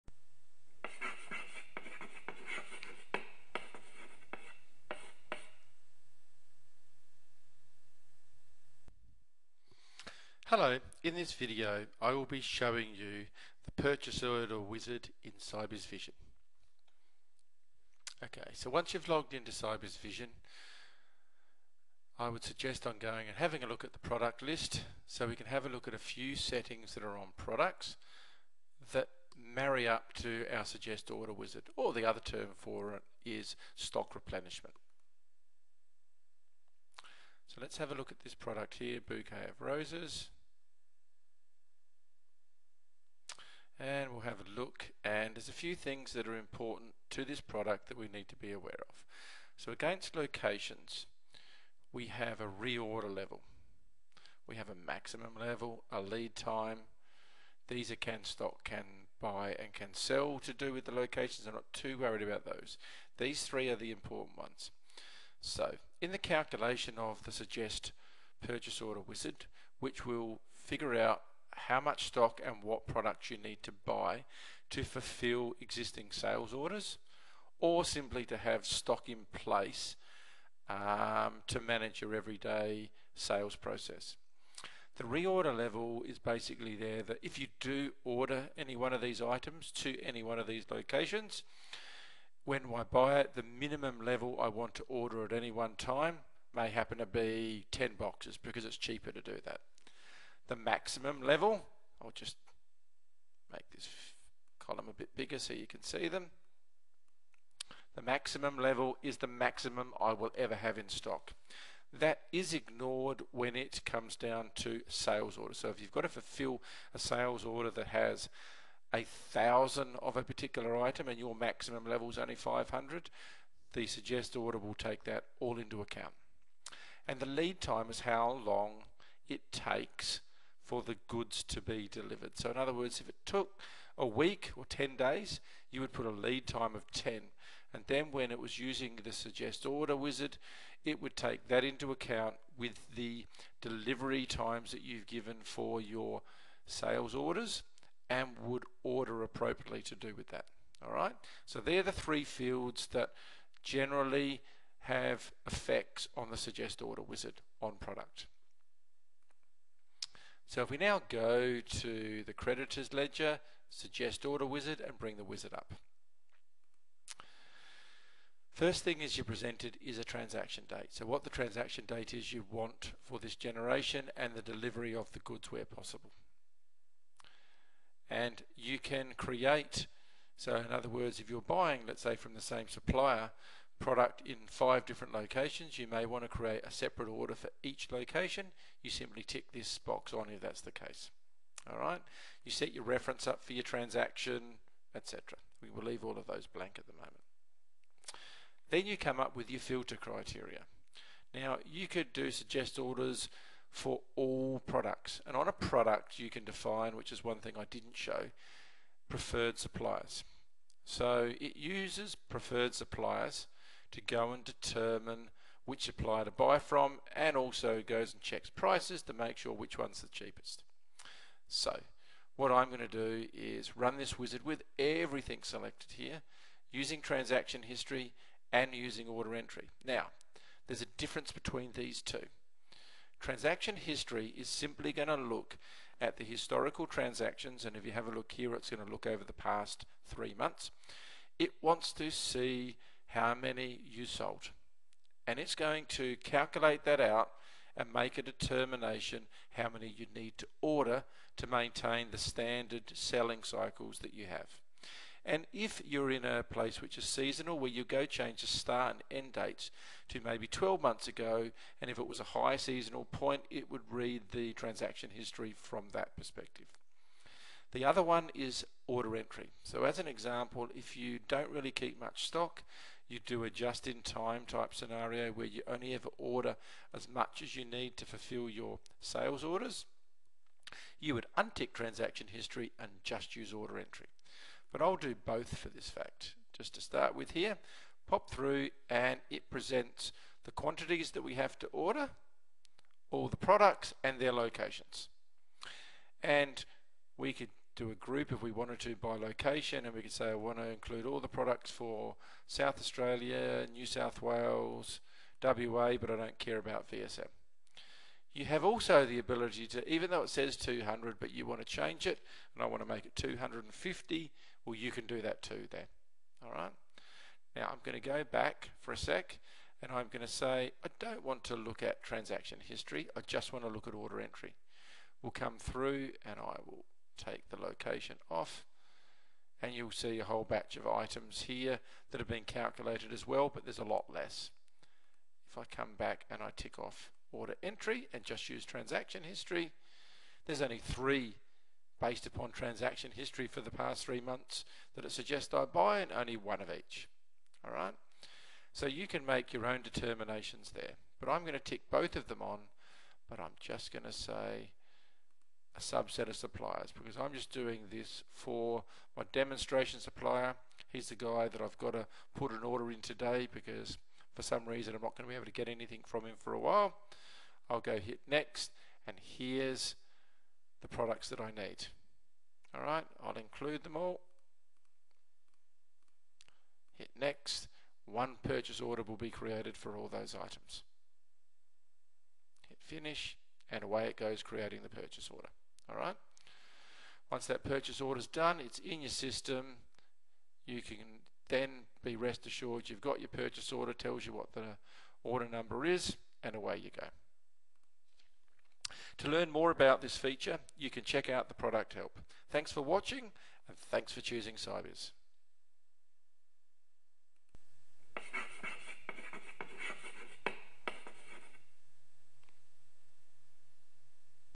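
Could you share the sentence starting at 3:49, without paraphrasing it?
Now there's a difference between these two.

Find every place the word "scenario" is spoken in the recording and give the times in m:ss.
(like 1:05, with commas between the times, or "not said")
4:34.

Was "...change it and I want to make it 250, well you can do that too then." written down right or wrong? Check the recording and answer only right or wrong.
right.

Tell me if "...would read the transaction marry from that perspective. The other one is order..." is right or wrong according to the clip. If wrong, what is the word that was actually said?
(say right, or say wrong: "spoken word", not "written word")
wrong: "history", not "marry".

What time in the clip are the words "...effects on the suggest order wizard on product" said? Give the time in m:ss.
2:35.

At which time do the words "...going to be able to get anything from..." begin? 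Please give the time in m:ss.
6:05.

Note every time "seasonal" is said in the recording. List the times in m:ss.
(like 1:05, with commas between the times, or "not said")
4:17, 4:22.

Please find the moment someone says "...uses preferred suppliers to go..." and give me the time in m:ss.
3:31.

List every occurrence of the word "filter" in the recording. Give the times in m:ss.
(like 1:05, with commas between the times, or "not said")
3:19.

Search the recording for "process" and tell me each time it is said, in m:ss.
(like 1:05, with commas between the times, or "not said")
1:23.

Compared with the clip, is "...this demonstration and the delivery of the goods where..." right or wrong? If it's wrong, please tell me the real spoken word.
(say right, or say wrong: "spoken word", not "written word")
wrong: "generation", not "demonstration".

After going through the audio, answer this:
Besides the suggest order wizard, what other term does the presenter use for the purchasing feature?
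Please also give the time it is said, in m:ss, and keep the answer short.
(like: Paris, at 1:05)
stock replenishment, at 0:33.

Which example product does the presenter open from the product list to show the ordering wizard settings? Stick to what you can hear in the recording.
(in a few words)
Bouquet of Roses.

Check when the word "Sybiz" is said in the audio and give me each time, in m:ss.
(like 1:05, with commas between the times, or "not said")
0:15, 0:19, 6:44.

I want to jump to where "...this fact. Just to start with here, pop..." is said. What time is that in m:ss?
4:45.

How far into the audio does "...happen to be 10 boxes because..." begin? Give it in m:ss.
1:36.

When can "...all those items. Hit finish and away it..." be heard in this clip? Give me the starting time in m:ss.
6:19.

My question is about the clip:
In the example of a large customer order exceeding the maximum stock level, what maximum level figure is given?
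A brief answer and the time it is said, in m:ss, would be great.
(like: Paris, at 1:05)
500, at 2:02.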